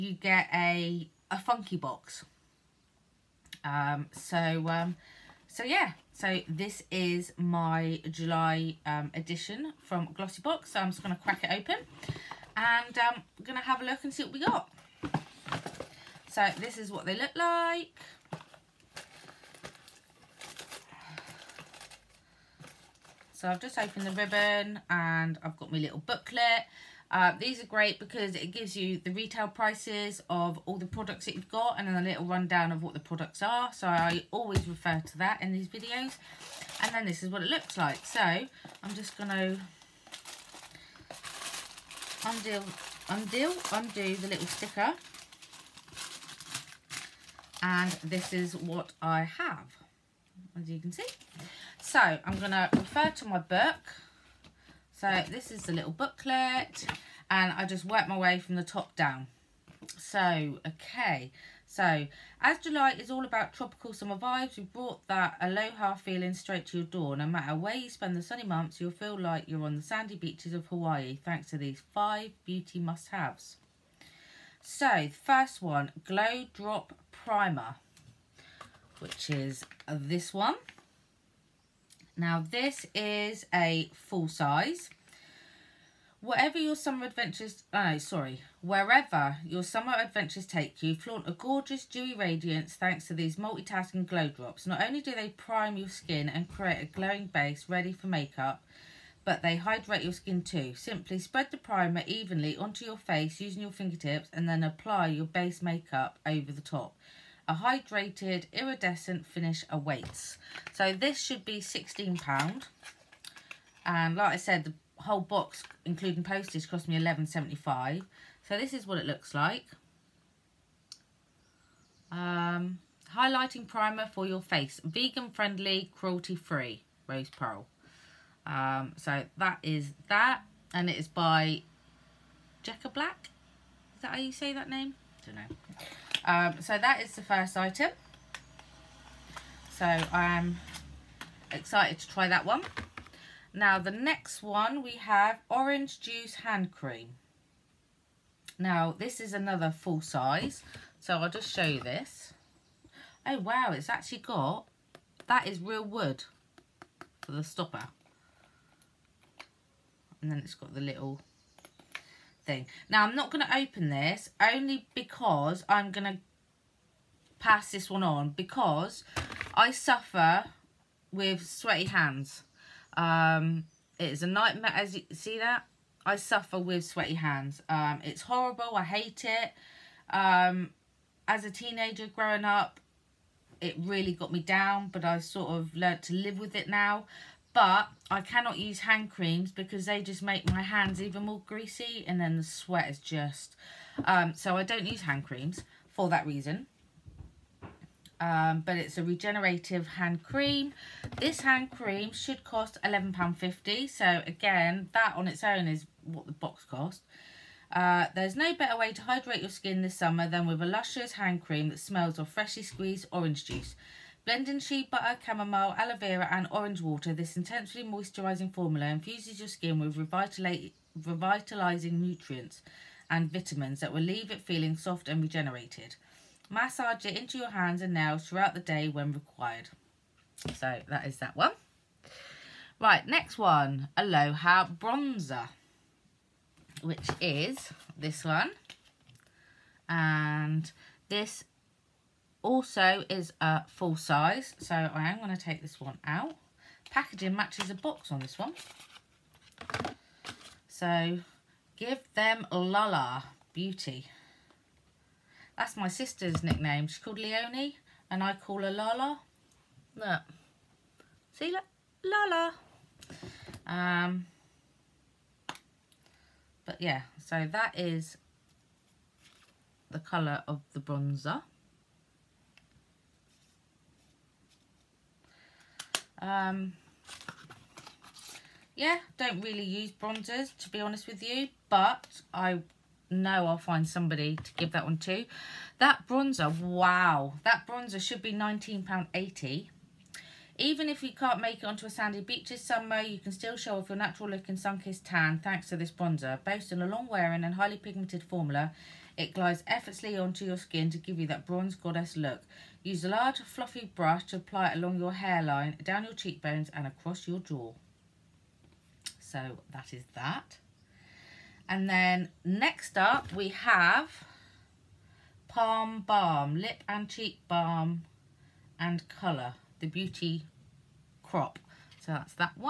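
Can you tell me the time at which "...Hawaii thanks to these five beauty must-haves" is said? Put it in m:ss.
1:10.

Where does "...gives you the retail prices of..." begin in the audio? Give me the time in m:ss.
0:28.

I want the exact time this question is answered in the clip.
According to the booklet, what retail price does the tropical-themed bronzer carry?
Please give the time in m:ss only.
4:48.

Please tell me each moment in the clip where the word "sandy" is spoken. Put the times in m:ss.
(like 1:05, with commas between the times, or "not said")
1:09, 4:51.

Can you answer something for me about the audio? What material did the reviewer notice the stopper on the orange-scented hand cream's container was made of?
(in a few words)
Wood.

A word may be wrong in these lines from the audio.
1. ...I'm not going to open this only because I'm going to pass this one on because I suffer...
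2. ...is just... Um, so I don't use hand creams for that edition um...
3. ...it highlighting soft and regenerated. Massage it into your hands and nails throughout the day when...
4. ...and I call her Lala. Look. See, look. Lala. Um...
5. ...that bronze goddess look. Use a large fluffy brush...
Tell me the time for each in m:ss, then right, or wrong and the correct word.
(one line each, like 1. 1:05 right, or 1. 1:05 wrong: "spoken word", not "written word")
1. 2:43 right
2. 3:12 wrong: "reason", not "edition"
3. 3:44 wrong: "feeling", not "highlighting"
4. 4:18 right
5. 5:01 right.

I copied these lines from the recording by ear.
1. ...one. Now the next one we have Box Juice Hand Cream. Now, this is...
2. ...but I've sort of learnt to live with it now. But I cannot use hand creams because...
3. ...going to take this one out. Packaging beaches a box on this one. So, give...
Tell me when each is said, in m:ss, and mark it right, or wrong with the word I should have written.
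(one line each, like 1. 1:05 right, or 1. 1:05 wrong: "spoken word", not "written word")
1. 2:22 wrong: "Orange", not "Box"
2. 3:04 right
3. 4:05 wrong: "matches", not "beaches".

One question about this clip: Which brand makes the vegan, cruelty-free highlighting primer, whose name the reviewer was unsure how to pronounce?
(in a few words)
Jecca Blac.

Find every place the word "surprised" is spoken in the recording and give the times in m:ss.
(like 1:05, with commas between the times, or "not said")
not said.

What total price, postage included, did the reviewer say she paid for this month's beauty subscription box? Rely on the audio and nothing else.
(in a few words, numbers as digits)
£11.75.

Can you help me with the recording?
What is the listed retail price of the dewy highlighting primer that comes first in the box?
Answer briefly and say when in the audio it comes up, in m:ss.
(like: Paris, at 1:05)
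£16, at 1:51.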